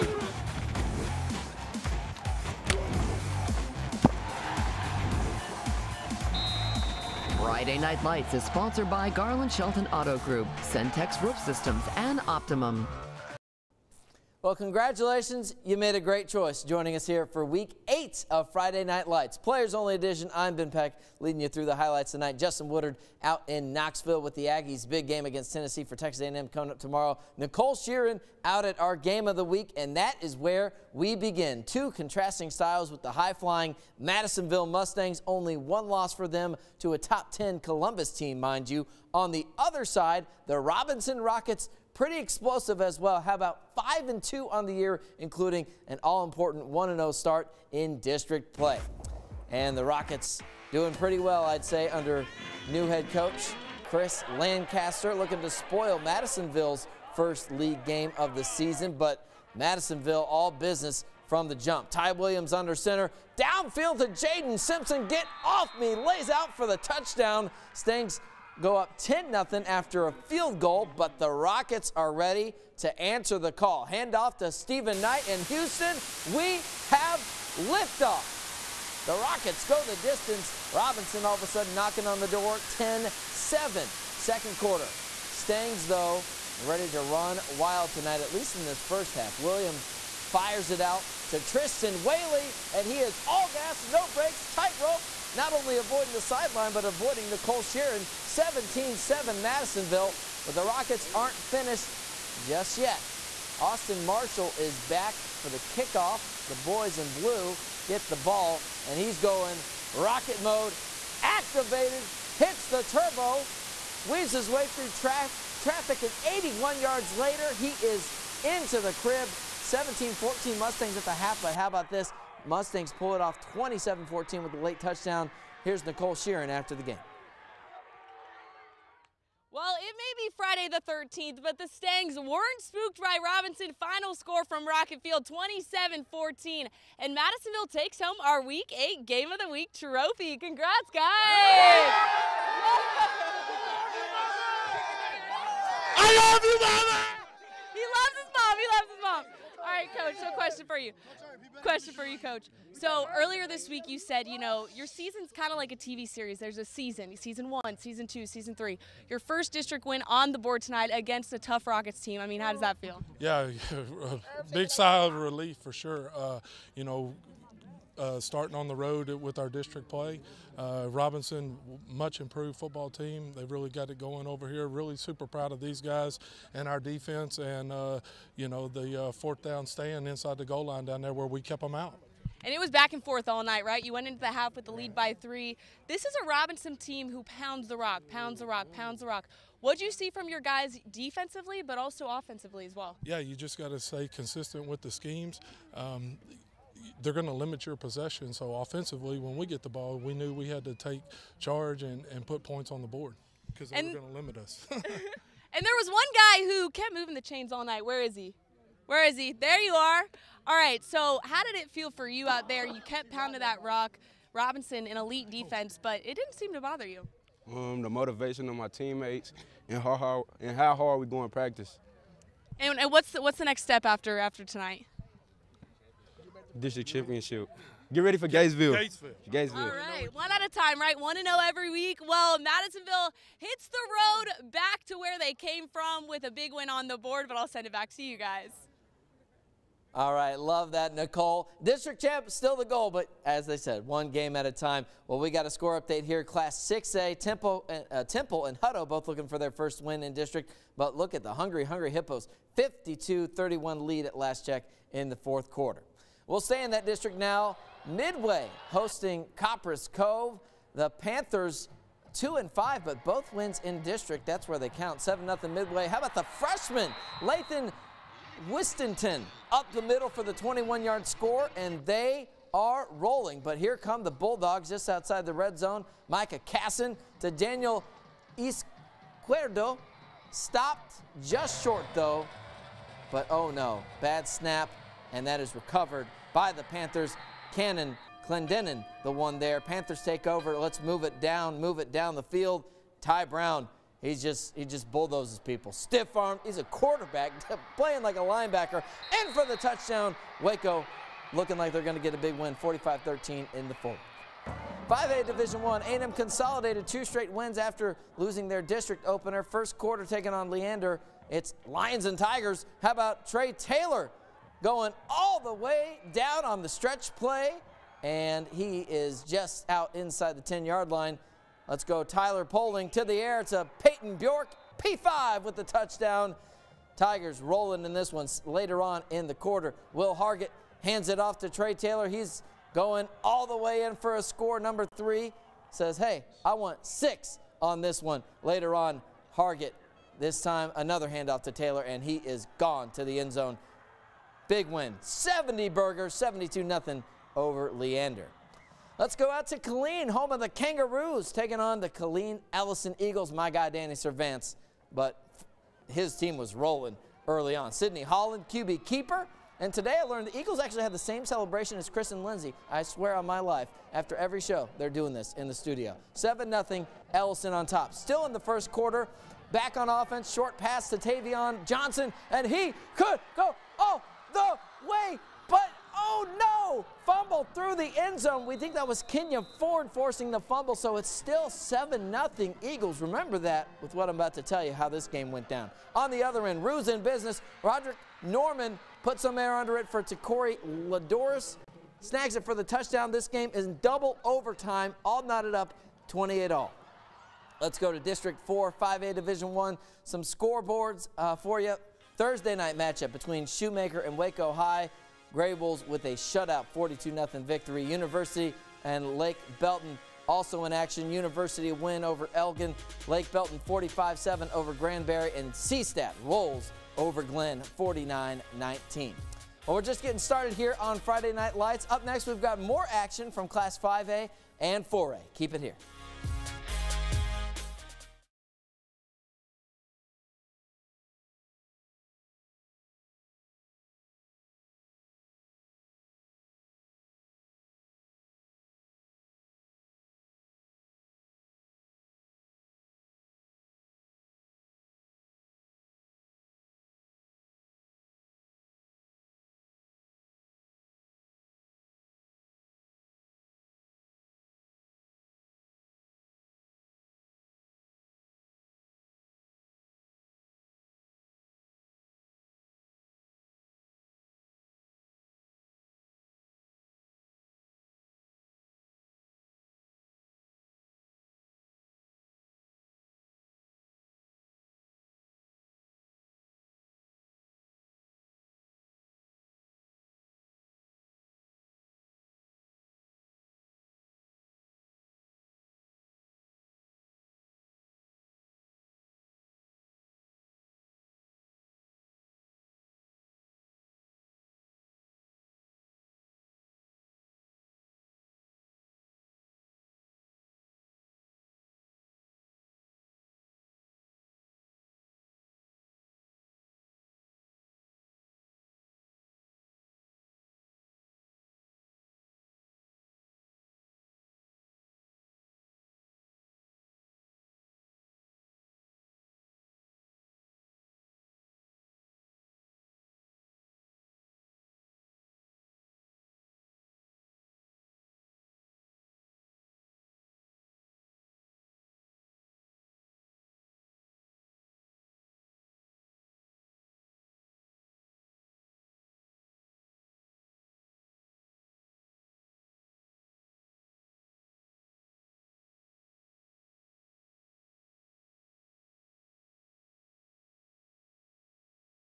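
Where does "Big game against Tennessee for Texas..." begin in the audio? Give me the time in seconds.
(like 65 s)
24 s.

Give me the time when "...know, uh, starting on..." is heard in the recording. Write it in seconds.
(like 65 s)
166 s.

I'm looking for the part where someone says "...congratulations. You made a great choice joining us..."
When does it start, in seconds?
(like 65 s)
14 s.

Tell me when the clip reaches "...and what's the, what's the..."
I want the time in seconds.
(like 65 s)
222 s.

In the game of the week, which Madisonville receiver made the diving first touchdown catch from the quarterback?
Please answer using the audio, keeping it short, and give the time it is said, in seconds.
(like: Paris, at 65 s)
Jaden Simpson, at 64 s.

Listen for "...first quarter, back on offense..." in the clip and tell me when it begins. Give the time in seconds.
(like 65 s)
368 s.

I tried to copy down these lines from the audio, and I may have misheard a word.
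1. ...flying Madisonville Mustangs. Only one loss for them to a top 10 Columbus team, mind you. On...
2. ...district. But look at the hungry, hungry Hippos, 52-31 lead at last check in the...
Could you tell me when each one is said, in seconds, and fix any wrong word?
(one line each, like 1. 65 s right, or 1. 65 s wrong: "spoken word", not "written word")
1. 33 s right
2. 250 s right.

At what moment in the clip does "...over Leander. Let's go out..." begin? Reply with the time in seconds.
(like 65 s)
347 s.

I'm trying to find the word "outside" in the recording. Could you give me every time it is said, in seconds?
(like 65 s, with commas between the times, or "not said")
274 s.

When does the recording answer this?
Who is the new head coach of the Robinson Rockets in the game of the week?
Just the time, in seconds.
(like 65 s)
53 s.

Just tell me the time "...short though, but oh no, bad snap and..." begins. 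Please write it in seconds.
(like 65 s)
281 s.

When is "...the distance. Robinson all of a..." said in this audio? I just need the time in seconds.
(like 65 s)
79 s.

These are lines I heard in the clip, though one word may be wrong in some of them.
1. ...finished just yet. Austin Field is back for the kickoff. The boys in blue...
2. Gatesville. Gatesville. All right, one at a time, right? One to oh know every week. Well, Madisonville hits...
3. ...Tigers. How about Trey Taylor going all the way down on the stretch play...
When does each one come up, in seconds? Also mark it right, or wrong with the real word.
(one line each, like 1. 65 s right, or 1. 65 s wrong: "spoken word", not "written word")
1. 101 s wrong: "Marshall", not "Field"
2. 228 s right
3. 312 s right.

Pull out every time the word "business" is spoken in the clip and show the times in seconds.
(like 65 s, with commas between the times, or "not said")
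60 s, 387 s.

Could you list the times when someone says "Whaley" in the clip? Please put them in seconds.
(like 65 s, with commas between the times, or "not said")
92 s.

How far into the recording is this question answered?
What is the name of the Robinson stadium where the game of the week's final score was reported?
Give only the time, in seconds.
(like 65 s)
134 s.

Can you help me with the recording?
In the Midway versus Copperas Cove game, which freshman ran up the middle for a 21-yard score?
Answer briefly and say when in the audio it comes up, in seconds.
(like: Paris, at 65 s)
Lathan Wistenton, at 267 s.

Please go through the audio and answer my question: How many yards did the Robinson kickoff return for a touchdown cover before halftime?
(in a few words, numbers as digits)
81.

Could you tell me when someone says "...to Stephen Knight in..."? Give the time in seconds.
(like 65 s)
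74 s.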